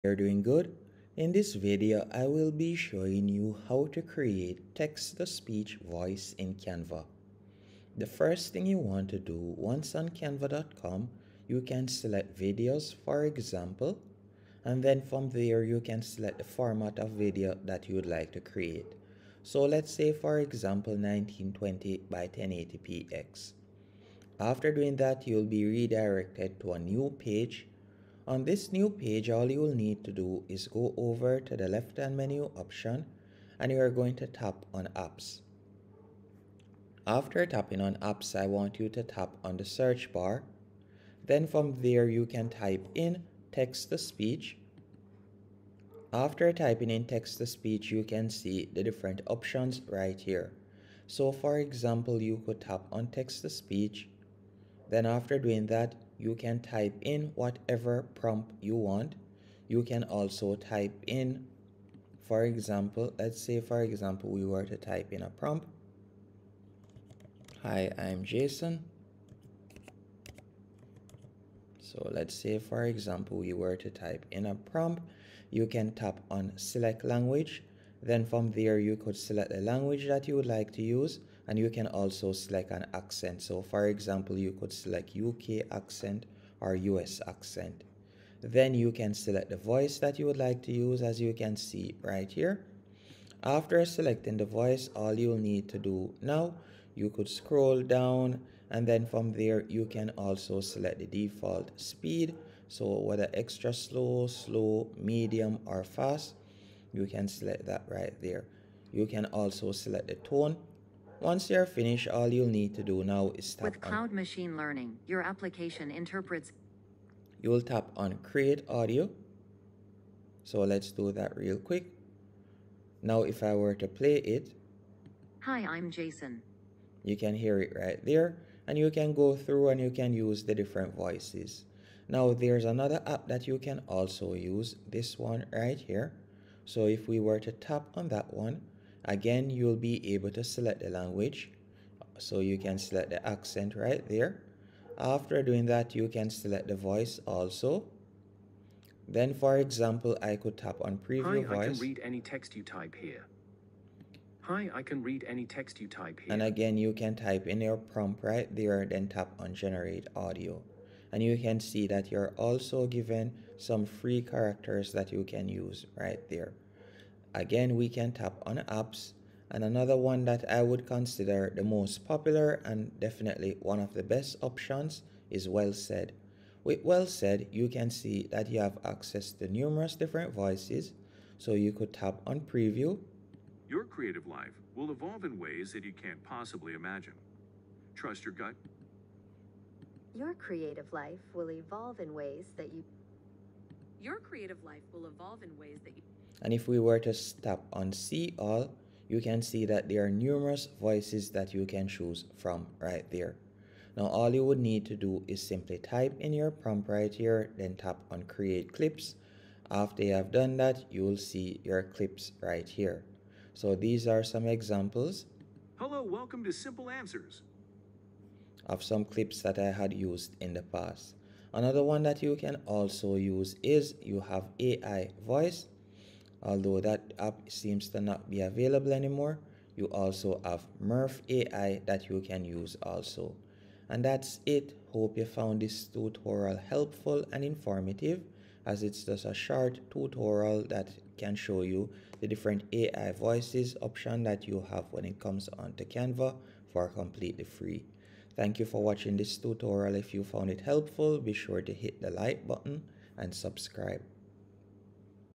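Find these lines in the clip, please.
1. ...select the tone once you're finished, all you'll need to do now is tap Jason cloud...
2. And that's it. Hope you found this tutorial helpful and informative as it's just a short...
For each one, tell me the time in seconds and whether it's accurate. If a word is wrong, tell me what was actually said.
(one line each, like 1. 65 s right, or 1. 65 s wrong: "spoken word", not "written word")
1. 109 s wrong: "With", not "Jason"
2. 233 s right.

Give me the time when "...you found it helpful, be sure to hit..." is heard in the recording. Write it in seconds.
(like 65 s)
250 s.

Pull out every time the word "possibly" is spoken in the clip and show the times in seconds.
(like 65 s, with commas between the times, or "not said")
186 s.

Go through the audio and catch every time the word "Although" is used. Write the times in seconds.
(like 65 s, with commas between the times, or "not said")
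226 s.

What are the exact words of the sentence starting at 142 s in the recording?
So you can select the accent right there.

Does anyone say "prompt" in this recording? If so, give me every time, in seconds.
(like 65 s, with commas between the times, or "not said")
58 s, 65 s, 74 s, 157 s, 206 s.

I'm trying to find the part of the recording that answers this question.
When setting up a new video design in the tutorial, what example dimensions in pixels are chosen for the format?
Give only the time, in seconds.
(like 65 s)
20 s.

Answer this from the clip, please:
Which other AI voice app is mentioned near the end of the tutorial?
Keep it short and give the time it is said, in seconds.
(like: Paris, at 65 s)
Murf AI, at 230 s.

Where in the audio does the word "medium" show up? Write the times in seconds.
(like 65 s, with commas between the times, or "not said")
104 s.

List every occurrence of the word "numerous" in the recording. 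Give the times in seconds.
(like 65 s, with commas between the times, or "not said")
179 s, 200 s.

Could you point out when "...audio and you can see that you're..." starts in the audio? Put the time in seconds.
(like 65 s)
160 s.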